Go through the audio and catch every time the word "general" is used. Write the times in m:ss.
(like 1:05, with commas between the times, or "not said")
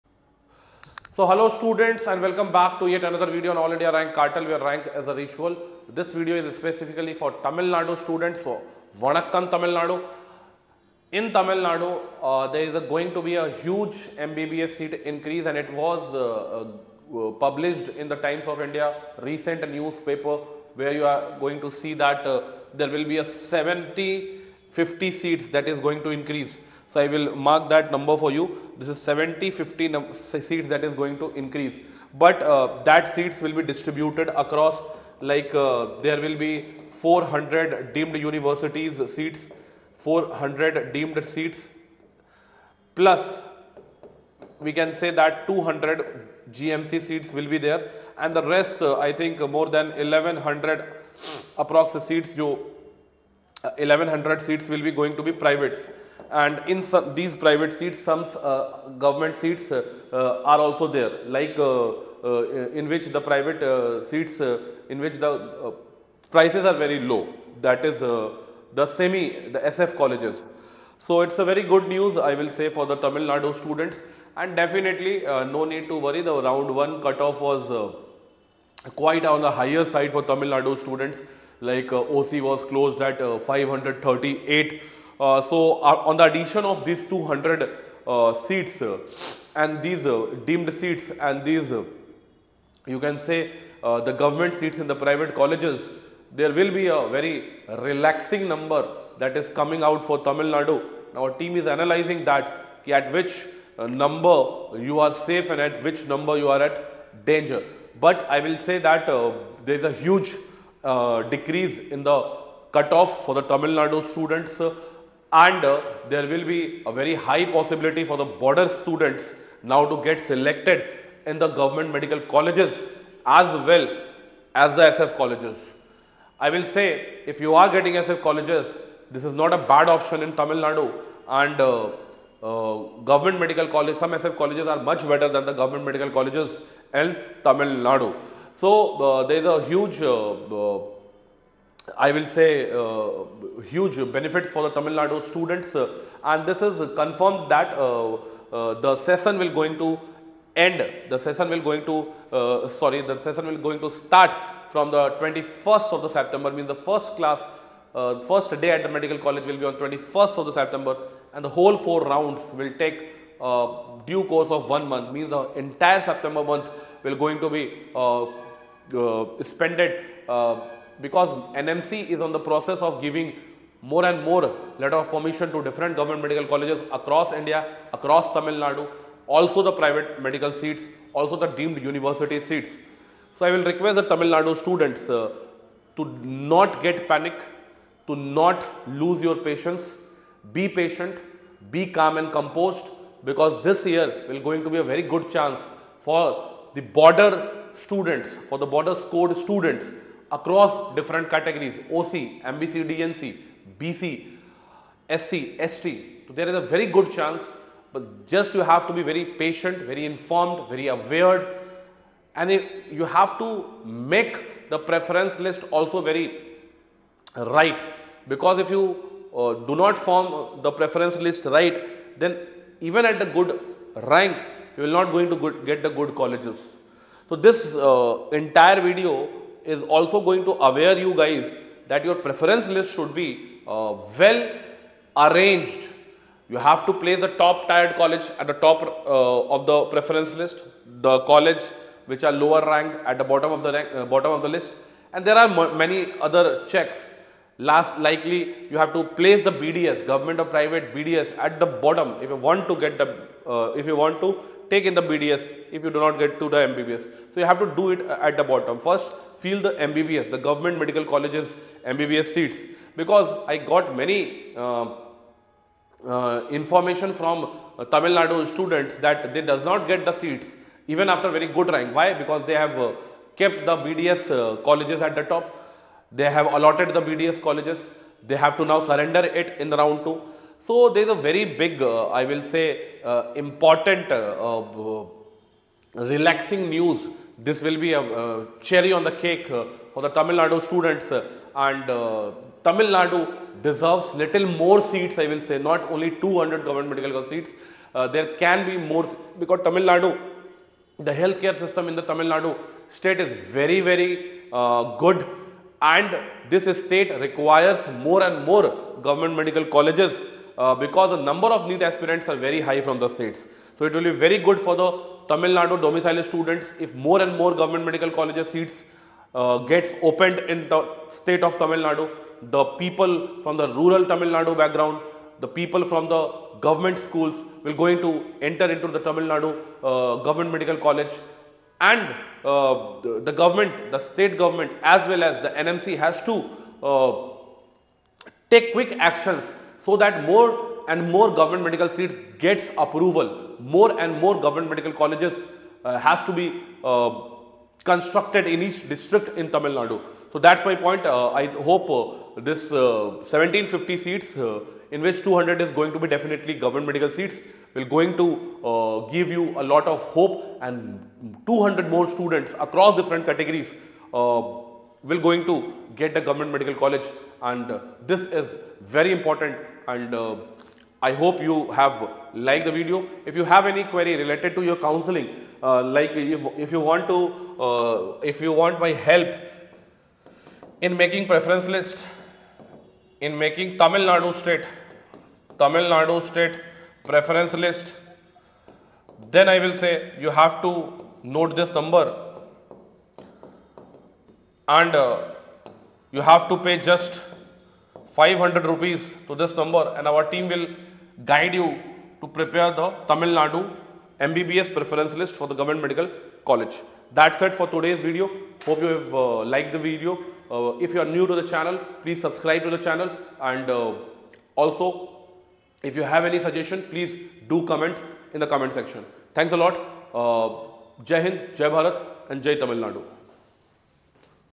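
not said.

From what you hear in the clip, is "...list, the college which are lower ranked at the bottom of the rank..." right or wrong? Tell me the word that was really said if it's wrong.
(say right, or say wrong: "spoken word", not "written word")
right.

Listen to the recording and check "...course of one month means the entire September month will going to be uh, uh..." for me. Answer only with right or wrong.
right.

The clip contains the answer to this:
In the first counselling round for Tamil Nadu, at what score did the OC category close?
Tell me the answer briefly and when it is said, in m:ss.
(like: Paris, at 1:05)
538, at 1:23.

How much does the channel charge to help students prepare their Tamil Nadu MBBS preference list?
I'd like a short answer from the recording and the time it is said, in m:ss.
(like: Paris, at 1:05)
500 rupees, at 6:38.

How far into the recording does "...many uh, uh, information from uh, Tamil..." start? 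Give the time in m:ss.
4:24.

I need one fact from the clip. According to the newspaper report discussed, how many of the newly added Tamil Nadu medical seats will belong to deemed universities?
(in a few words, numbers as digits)
400.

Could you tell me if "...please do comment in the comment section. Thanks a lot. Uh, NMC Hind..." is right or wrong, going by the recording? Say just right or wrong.
wrong.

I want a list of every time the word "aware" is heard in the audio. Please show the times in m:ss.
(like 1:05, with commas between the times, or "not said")
3:30, 3:50.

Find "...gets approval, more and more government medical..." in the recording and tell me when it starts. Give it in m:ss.
5:42.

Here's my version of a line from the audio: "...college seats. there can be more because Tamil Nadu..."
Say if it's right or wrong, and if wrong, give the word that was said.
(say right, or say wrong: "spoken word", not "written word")
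right.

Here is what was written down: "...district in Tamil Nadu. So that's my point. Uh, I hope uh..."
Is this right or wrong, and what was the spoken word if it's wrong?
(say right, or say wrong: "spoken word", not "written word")
right.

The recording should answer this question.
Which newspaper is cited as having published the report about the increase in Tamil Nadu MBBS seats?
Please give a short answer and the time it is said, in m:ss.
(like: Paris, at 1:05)
Times of India, at 0:18.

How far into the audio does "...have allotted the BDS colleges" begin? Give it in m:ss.
4:36.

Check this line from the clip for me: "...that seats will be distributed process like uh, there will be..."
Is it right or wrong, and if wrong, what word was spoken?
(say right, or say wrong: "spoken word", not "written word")
wrong: "across", not "process".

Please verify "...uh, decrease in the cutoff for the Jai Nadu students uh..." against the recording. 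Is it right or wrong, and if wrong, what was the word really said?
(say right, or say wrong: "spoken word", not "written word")
wrong: "Tamil", not "Jai".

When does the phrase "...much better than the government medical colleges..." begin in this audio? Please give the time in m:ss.
2:14.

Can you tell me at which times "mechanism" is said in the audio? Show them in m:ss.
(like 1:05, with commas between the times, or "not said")
not said.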